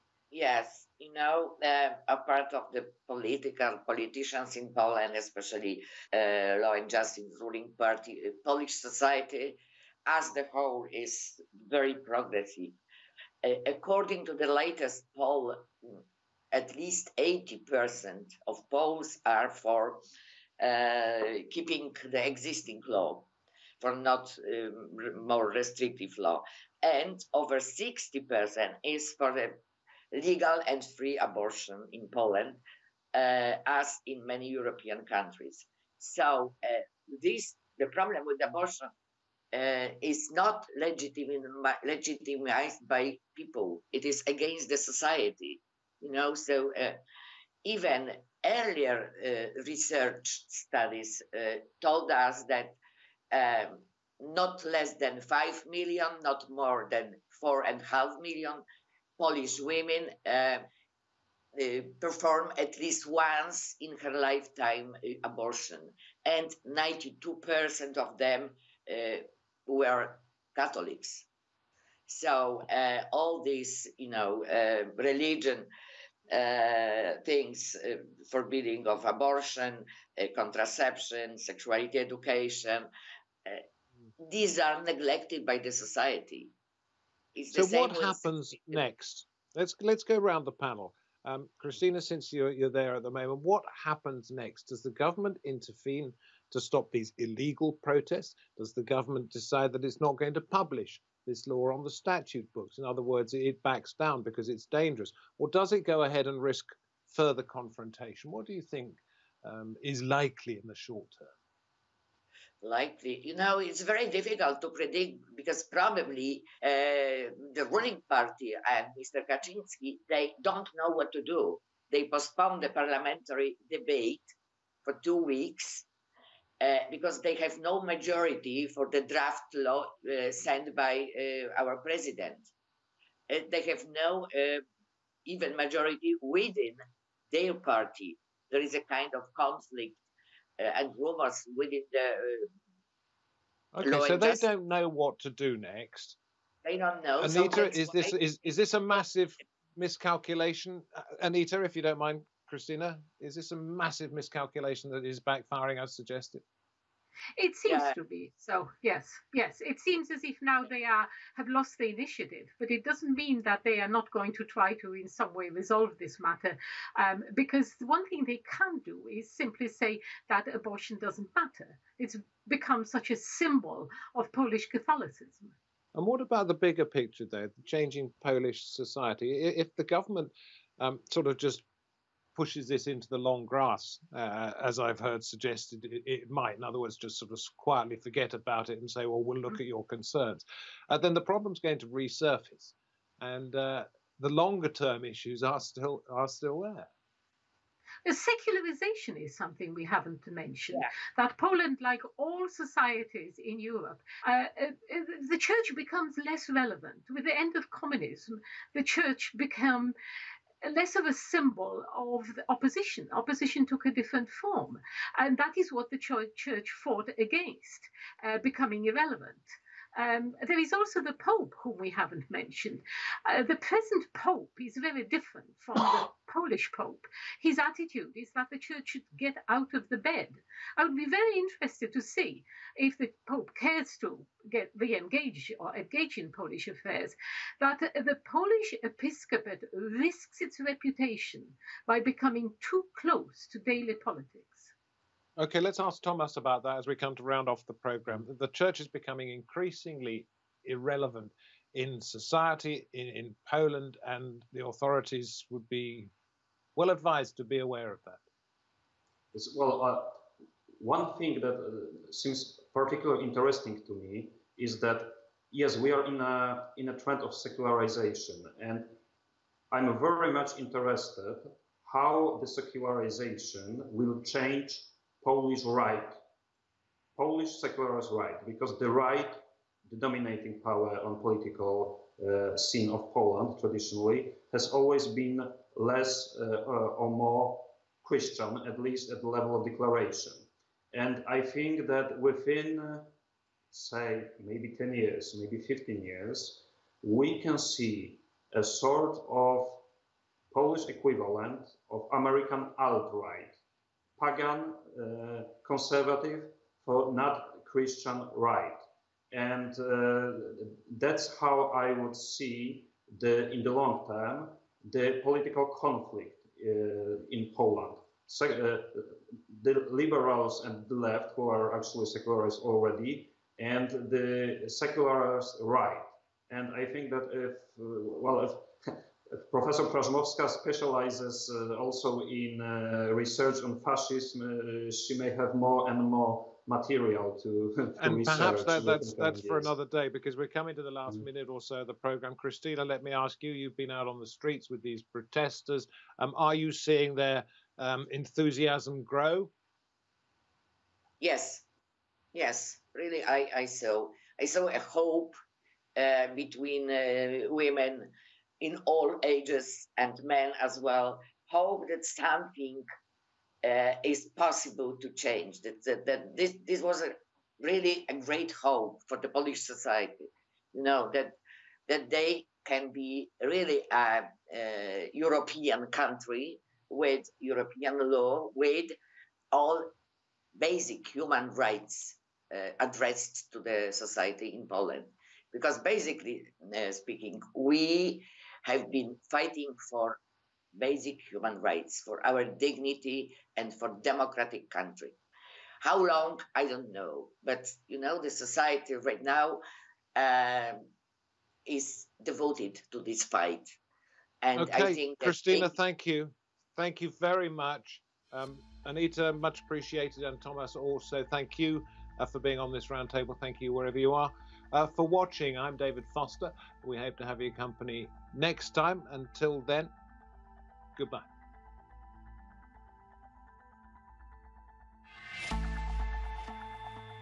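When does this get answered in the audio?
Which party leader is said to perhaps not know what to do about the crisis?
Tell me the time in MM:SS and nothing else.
01:58.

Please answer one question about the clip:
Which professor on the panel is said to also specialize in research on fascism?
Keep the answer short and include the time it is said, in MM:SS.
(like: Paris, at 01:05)
Prazmowska, at 05:29.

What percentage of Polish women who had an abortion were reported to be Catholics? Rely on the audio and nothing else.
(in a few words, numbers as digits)
92%.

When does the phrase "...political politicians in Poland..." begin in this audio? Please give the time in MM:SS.
00:03.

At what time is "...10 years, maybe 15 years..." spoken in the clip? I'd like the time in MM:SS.
04:54.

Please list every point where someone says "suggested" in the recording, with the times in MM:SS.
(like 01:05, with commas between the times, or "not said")
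02:35, 03:05.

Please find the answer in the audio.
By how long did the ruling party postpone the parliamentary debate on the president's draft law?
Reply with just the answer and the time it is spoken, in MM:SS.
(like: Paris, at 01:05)
two weeks, at 02:05.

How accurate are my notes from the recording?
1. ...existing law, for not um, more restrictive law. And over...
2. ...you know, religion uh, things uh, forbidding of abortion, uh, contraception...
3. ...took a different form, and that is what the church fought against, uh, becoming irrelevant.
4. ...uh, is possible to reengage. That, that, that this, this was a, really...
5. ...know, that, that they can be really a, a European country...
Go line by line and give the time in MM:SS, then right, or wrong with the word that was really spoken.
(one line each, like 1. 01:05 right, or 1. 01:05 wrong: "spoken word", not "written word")
1. 00:22 right
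2. 01:13 right
3. 03:33 right
4. 06:03 wrong: "change", not "reengage"
5. 06:10 right.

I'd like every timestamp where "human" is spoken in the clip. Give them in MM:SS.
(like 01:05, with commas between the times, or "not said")
06:21, 06:31.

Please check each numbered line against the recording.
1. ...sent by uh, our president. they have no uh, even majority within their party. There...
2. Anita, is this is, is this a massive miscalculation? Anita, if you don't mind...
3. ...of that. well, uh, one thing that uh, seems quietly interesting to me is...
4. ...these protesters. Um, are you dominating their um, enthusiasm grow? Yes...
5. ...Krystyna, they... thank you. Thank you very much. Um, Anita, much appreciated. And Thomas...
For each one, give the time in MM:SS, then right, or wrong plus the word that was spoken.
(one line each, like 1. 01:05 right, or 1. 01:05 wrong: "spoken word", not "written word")
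1. 02:10 right
2. 02:27 right
3. 04:17 wrong: "particularly", not "quietly"
4. 05:44 wrong: "seeing", not "dominating"
5. 06:45 right.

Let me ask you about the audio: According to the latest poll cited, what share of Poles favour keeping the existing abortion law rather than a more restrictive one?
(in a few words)
80%.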